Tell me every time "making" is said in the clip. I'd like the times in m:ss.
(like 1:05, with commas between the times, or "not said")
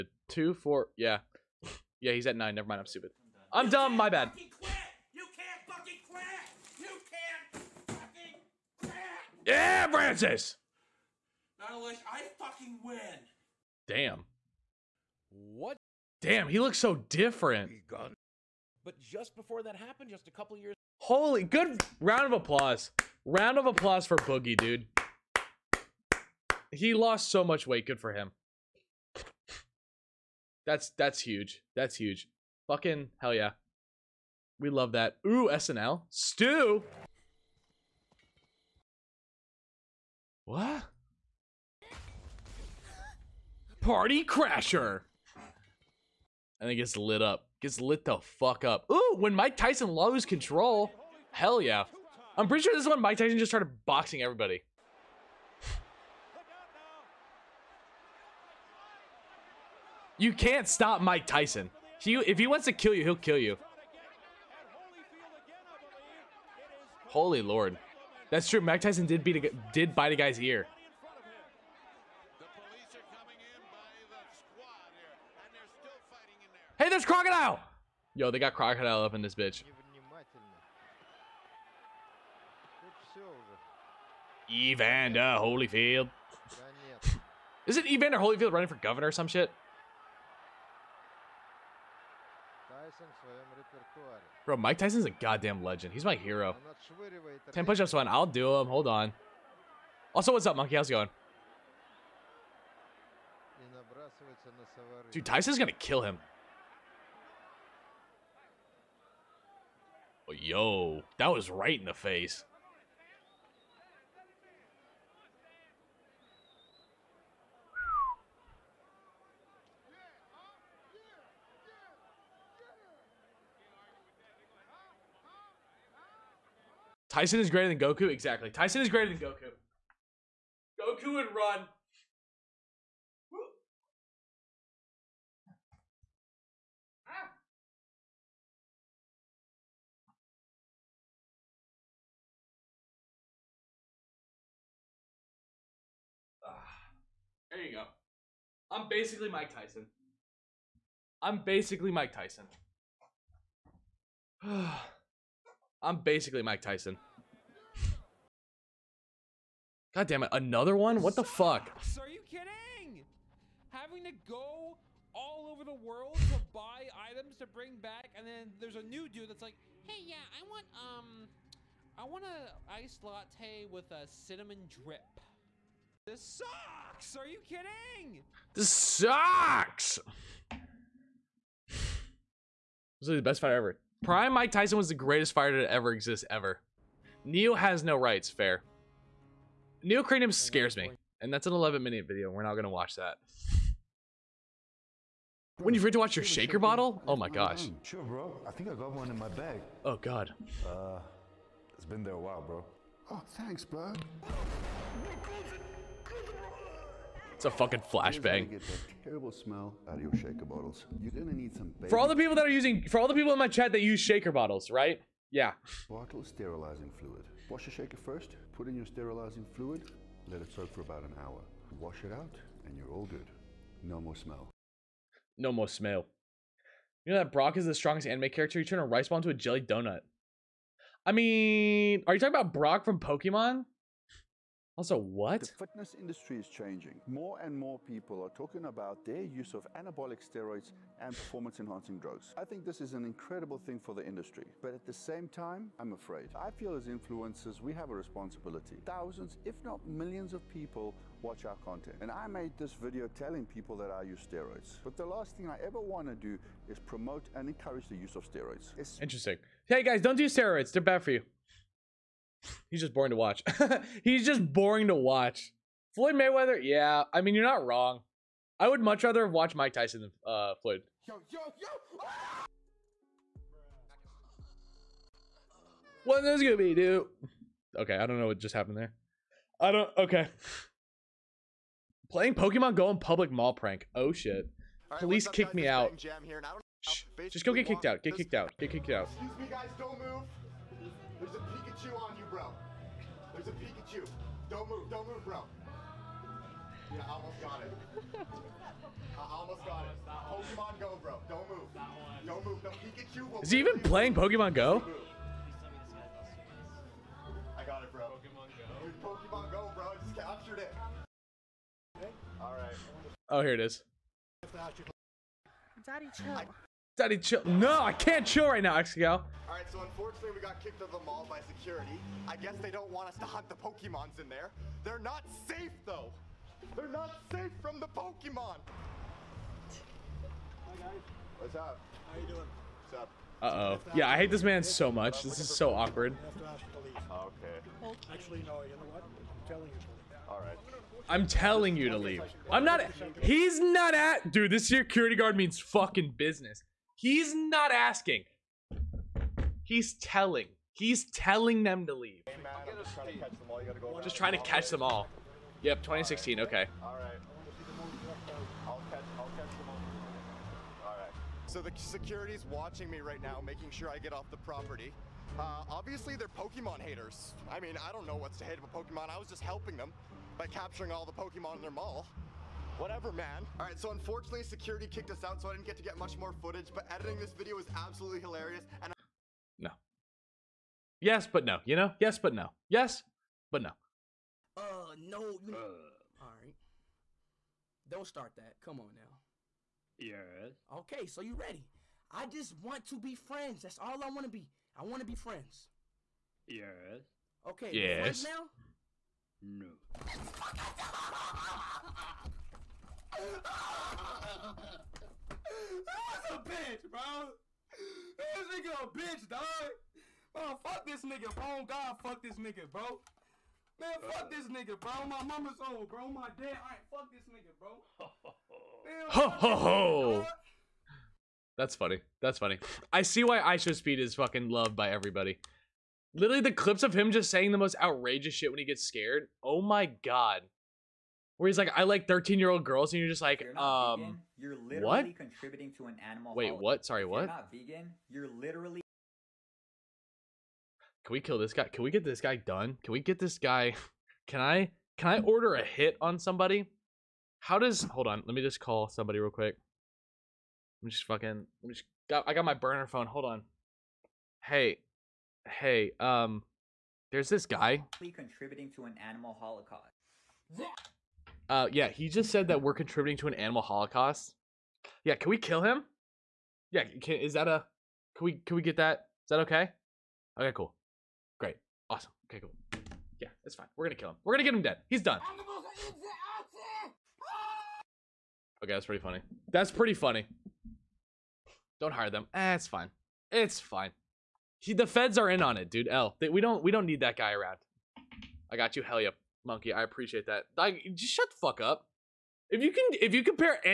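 6:03.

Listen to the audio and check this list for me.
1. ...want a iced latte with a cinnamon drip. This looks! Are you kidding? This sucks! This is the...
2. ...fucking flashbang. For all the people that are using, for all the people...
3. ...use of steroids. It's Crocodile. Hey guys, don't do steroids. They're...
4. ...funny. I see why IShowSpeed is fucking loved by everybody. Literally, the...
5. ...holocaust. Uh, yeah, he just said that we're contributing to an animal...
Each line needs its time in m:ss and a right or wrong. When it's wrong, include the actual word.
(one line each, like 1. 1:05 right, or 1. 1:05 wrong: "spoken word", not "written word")
1. 2:52 wrong: "sucks", not "looks"
2. 3:27 right
3. 4:17 wrong: "Interesting", not "Crocodile"
4. 7:02 right
5. 7:39 right.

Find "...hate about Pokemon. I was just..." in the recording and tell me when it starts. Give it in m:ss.
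6:08.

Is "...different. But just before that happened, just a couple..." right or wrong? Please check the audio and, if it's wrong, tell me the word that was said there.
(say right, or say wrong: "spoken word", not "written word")
right.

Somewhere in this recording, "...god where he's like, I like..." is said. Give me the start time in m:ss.
7:09.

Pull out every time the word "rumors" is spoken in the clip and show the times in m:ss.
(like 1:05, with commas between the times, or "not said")
not said.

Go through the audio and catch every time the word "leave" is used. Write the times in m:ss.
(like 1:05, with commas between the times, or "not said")
5:41, 5:51.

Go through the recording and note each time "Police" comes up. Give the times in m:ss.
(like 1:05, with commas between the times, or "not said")
4:44.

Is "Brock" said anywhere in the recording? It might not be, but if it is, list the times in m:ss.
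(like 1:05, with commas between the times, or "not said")
3:47, 3:52.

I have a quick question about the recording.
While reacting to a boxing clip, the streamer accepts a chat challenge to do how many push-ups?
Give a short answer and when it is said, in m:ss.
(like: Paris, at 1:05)
10, at 1:37.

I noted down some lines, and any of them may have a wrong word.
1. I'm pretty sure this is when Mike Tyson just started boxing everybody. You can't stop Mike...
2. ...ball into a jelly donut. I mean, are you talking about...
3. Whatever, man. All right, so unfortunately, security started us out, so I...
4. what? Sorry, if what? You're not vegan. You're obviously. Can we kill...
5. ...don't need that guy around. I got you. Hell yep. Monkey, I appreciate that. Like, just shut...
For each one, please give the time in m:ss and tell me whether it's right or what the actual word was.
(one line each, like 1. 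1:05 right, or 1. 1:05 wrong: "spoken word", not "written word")
1. 0:52 right
2. 3:49 right
3. 6:12 wrong: "kicked", not "started"
4. 7:16 wrong: "literally", not "obviously"
5. 8:06 right.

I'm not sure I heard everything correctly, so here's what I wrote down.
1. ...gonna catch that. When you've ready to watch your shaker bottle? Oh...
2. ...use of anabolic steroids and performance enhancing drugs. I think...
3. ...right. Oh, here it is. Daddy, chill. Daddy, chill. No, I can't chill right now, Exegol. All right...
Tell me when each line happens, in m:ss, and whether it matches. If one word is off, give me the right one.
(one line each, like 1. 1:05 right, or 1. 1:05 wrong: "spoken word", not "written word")
1. 3:12 wrong: "watch", not "catch"
2. 3:59 right
3. 5:12 right.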